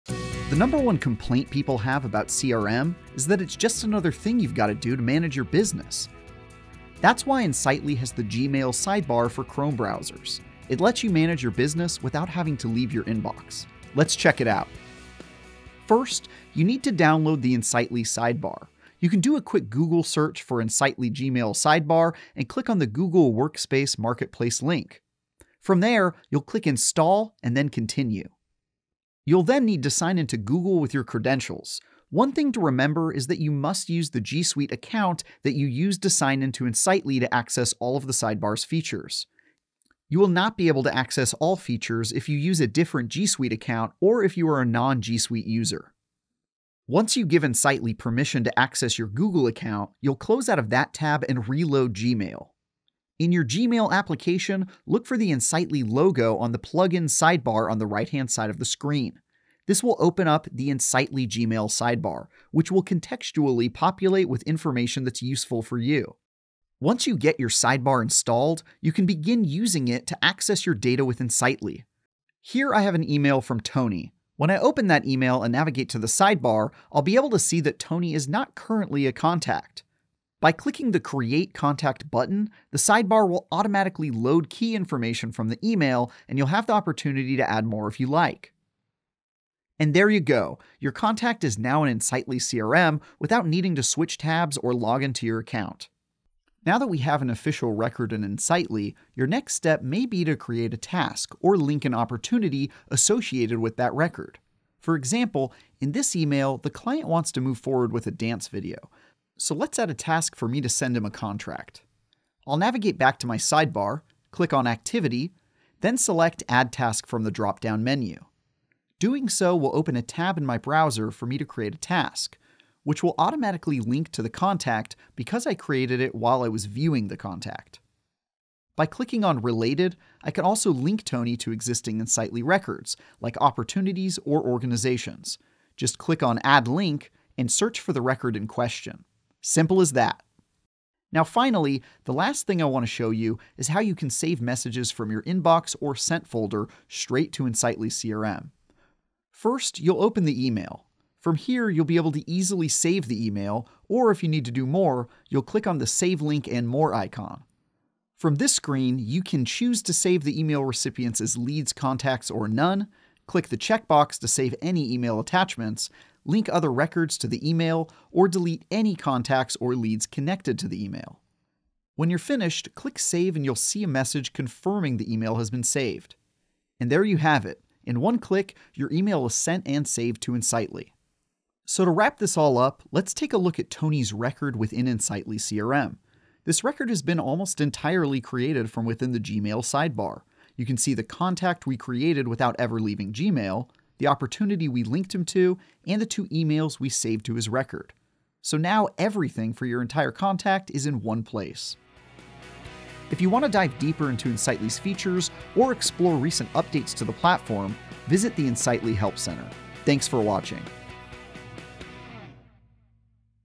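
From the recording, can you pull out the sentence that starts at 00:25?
From there, you'll click Install and then Continue.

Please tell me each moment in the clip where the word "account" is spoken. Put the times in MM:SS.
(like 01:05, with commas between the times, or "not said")
00:34, 00:43, 00:49, 01:35.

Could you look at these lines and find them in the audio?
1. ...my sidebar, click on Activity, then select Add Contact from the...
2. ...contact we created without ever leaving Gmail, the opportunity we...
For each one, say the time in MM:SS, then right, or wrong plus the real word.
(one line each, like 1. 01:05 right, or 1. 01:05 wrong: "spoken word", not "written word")
1. 01:53 wrong: "Task", not "Contact"
2. 03:11 right.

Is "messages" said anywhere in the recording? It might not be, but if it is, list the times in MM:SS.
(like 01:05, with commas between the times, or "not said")
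02:24, 02:53.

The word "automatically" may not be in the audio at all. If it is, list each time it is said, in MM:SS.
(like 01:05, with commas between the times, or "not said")
01:23, 02:03.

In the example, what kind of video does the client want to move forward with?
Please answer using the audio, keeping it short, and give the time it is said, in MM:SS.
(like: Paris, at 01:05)
dance video, at 01:48.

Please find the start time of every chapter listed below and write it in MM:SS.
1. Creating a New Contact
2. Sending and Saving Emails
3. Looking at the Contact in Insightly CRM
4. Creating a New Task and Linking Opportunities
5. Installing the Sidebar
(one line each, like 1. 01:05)
1. 01:06
2. 02:20
3. 03:01
4. 01:35
5. 00:14.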